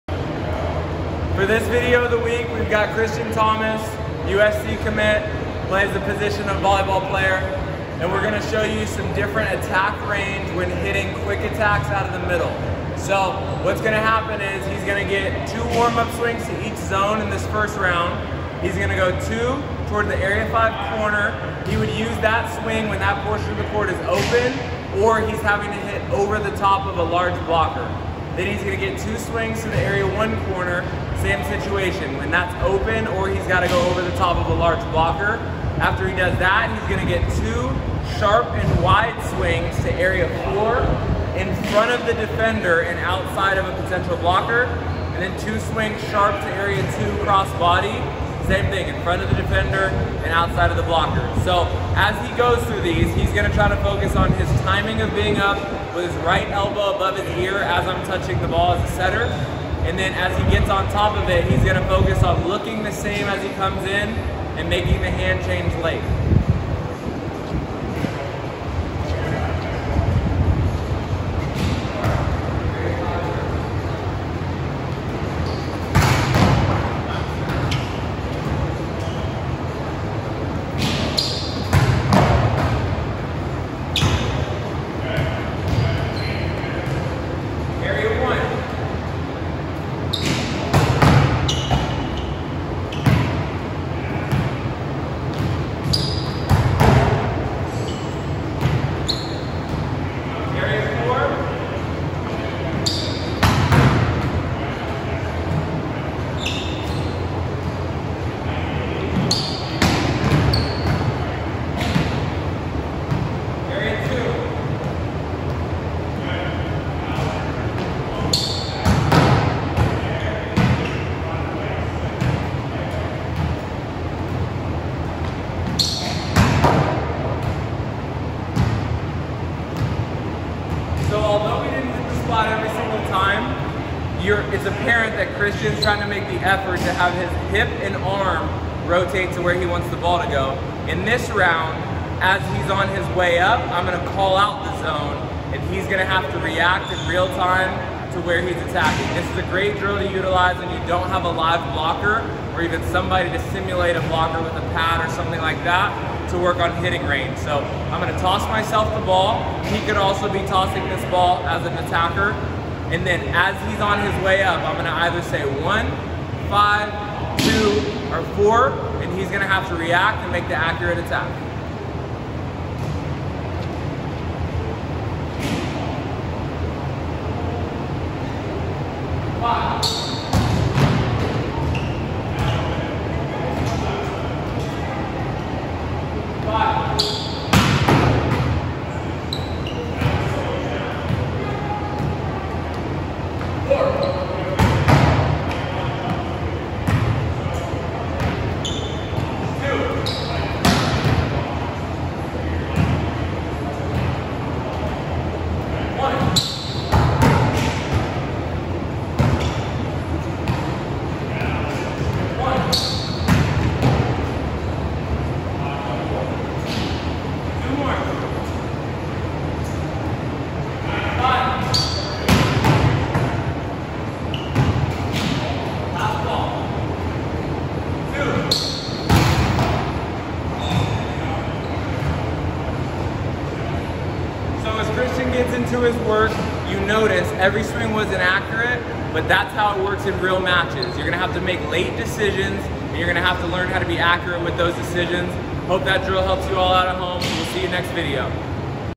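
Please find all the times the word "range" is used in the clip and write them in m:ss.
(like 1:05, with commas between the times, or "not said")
0:10, 2:37.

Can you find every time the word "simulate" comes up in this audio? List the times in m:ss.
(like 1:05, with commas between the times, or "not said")
2:33.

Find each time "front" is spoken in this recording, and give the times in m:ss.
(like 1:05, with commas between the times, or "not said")
0:41, 0:49.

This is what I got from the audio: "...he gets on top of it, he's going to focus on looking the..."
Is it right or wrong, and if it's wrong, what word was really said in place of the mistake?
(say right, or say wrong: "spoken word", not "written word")
right.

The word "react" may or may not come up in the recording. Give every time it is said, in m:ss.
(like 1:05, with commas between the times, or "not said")
2:26, 2:49.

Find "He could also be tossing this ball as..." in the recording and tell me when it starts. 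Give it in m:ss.
2:39.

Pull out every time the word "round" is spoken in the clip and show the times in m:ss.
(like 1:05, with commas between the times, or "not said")
0:17, 2:21.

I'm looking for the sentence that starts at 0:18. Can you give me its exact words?
He's gonna go two toward the area five corner.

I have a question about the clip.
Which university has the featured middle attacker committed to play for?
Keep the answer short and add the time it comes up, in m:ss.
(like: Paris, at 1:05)
USC, at 0:04.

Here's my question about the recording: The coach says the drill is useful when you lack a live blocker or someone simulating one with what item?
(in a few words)
a pad.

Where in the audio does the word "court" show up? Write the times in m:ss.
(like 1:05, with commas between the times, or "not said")
0:23.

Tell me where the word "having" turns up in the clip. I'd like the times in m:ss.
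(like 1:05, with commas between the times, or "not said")
0:25.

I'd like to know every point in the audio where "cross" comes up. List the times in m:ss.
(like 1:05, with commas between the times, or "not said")
0:47.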